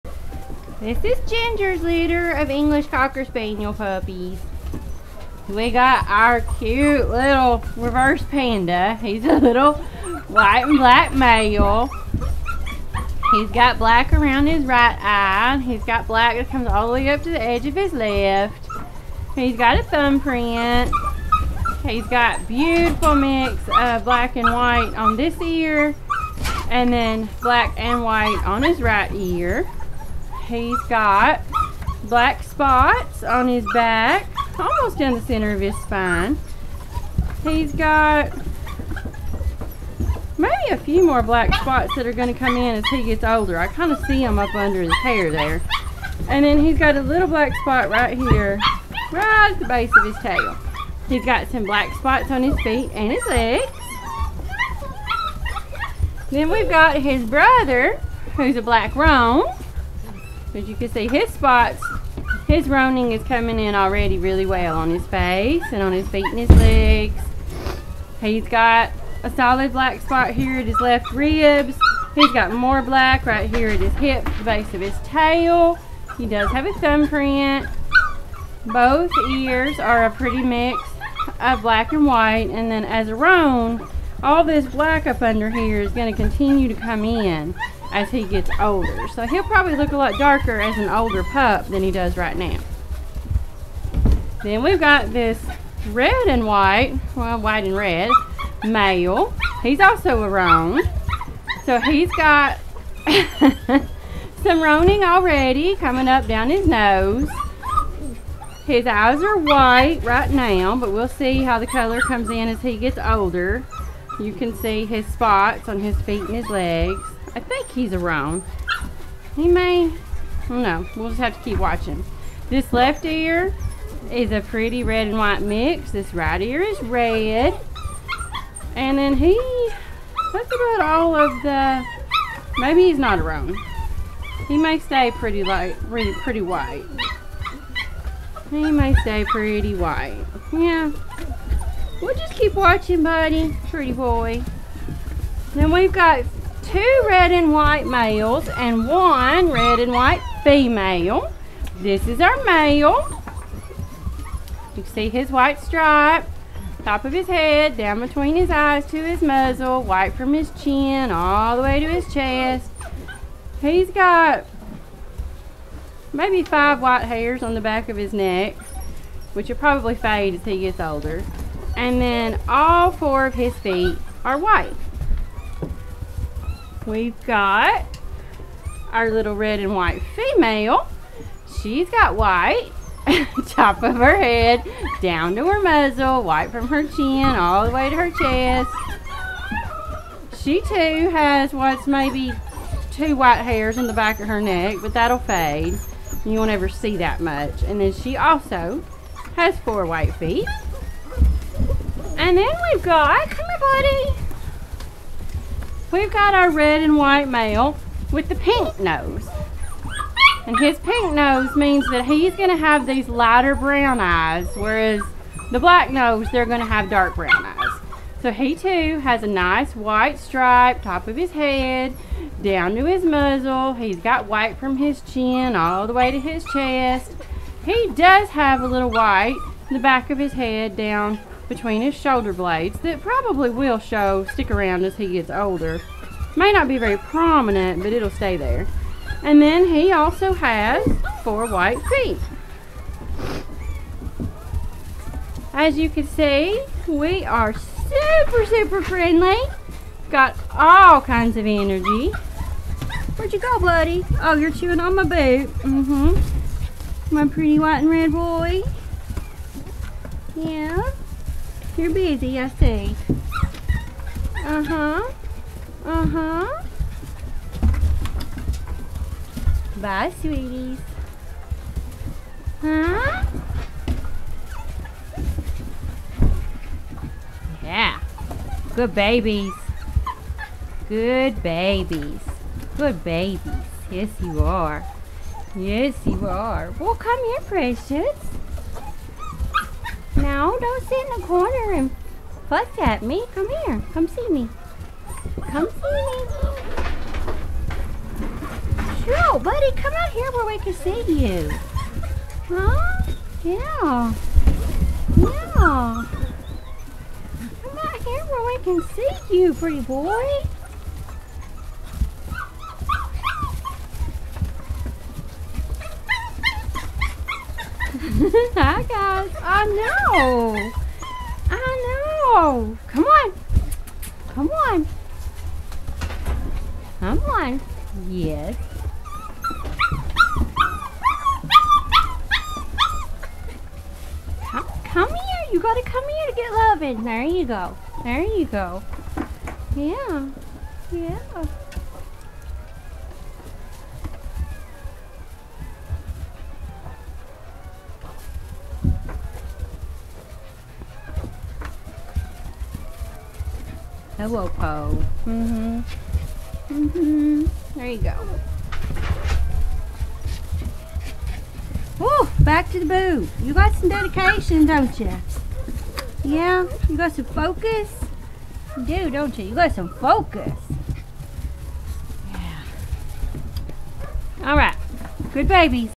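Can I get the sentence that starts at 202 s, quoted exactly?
And then we've got, come here buddy, we've got our red and white male with the pink nose.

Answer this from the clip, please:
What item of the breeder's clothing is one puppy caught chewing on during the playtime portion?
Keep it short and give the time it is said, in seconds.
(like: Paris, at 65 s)
boot, at 254 s.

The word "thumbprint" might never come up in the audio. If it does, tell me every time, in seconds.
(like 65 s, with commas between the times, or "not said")
19 s, 76 s.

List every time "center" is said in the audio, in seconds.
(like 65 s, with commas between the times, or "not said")
35 s.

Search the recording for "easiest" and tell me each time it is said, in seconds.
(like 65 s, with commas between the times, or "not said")
not said.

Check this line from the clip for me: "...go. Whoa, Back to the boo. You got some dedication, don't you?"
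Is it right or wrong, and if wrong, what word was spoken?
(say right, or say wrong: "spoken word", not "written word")
right.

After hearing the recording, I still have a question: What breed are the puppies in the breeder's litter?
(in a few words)
English Cocker Spaniel.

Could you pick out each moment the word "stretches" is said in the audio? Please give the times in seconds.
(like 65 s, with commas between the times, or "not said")
not said.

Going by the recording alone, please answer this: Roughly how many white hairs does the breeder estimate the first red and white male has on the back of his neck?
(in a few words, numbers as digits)
5.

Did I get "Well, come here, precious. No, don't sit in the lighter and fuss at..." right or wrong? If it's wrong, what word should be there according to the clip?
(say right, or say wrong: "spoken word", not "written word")
wrong: "corner", not "lighter".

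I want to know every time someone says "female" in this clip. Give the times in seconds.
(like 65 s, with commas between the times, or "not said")
150 s, 180 s.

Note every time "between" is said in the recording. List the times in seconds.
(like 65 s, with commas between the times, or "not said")
157 s, 231 s.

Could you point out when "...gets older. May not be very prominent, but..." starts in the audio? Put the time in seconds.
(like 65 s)
235 s.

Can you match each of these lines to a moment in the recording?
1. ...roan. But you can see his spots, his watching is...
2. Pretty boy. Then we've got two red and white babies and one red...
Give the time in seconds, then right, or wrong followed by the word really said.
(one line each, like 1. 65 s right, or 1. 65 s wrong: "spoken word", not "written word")
1. 58 s wrong: "roaning", not "watching"
2. 143 s wrong: "males", not "babies".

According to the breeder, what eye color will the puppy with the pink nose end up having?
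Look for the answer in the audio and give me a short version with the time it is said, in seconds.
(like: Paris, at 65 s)
lighter brown, at 213 s.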